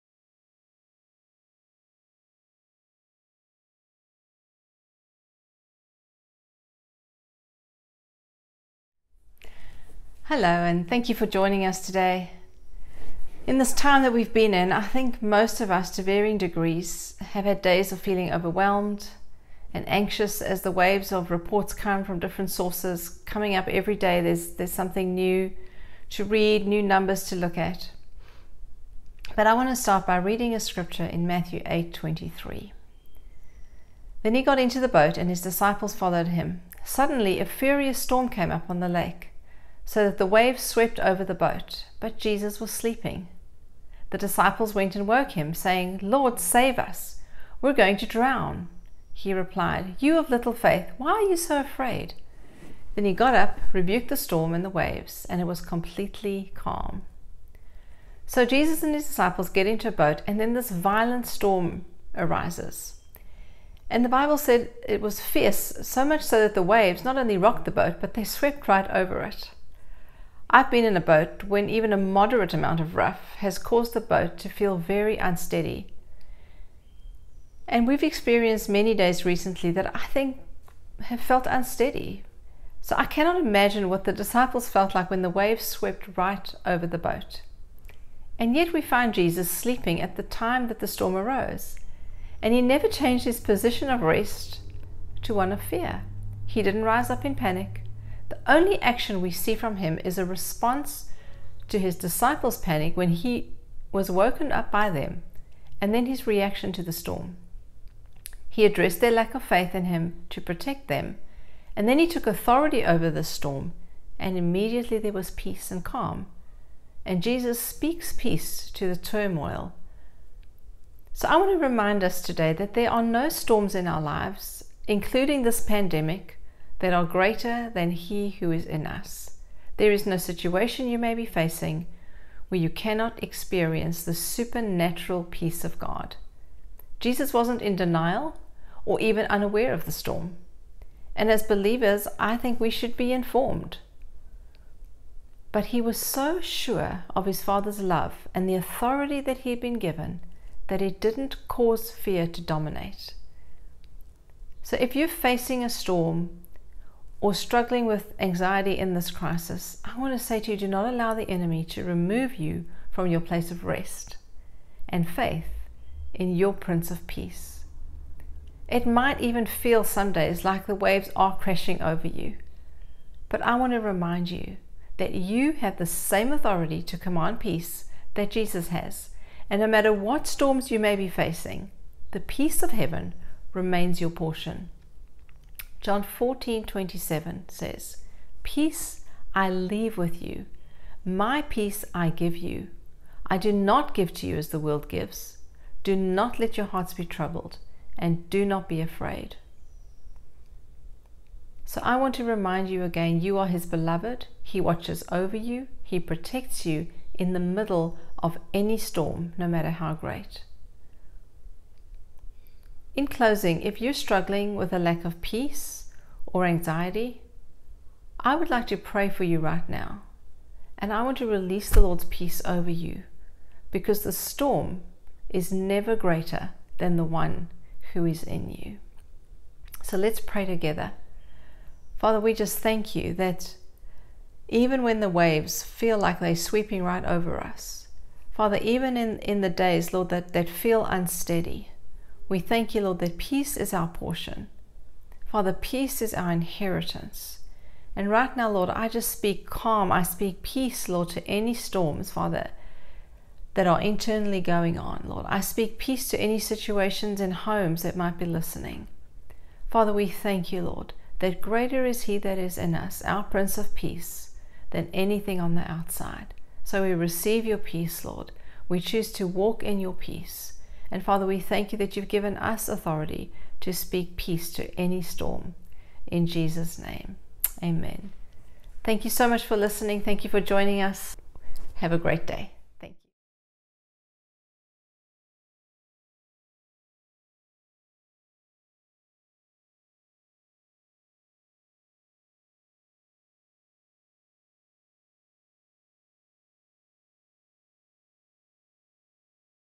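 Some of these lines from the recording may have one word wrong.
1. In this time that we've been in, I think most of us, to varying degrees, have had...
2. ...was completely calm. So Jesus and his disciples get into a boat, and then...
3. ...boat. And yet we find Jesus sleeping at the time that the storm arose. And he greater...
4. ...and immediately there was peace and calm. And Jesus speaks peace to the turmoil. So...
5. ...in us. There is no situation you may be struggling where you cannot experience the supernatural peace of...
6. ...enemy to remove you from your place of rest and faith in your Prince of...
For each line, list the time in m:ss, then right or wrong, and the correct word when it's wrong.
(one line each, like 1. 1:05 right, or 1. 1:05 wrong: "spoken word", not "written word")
1. 0:13 right
2. 0:55 right
3. 1:26 wrong: "never", not "greater"
4. 1:54 right
5. 2:08 wrong: "facing", not "struggling"
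6. 2:41 right.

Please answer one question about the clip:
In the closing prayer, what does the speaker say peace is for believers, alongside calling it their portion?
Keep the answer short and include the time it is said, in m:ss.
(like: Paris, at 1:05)
Our inheritance, at 4:06.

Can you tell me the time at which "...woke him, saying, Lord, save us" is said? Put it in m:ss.
0:45.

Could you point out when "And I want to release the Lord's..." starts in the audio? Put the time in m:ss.
3:40.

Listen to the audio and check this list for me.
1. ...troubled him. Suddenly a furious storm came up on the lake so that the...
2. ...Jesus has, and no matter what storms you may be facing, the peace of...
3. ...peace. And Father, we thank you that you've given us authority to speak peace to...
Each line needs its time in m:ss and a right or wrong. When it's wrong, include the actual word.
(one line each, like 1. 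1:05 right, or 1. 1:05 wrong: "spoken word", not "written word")
1. 0:35 wrong: "followed", not "troubled"
2. 2:58 right
3. 4:29 right.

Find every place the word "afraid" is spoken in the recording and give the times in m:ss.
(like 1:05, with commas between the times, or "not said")
0:51, 3:18.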